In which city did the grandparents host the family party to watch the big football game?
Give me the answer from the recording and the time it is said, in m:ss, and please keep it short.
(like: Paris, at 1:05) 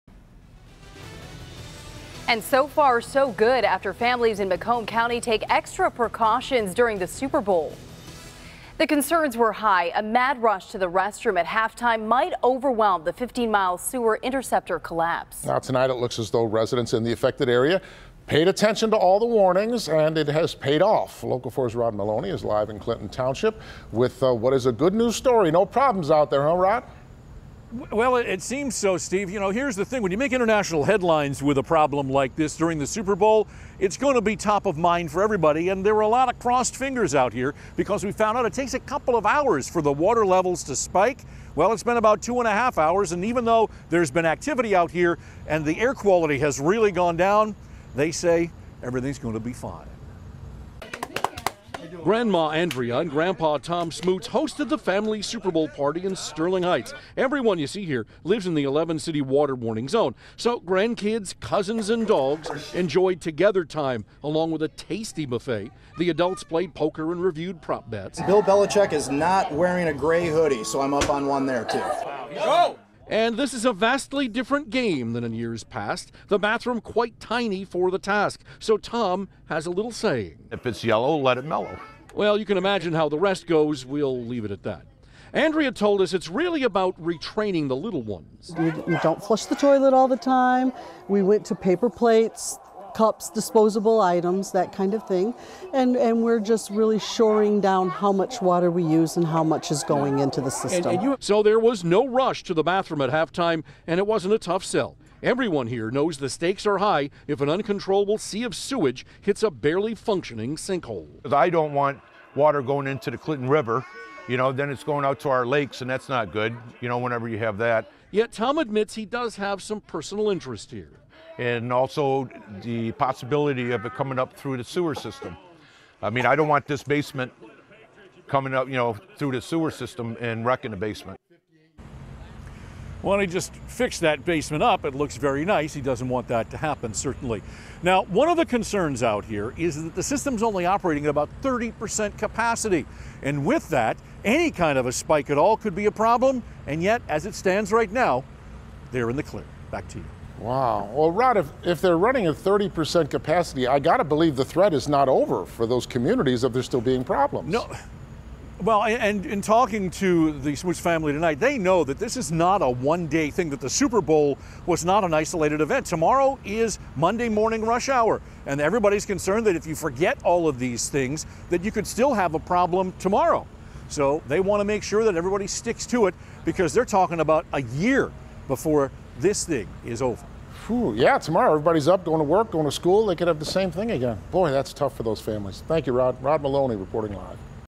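Sterling Heights, at 0:56.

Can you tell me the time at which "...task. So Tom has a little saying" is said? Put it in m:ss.
1:17.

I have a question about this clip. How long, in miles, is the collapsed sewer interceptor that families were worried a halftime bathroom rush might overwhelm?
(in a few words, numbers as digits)
15.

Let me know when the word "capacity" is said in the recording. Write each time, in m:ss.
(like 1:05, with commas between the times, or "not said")
2:22, 2:33.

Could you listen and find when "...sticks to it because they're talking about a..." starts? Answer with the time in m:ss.
2:55.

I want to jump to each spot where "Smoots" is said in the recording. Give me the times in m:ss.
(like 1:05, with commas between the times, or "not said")
0:53, 2:40.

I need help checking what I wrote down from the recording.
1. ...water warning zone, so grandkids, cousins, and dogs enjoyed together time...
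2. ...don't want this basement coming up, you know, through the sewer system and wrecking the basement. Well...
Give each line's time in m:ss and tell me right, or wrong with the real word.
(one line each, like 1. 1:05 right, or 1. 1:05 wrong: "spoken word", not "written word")
1. 0:59 right
2. 2:06 right.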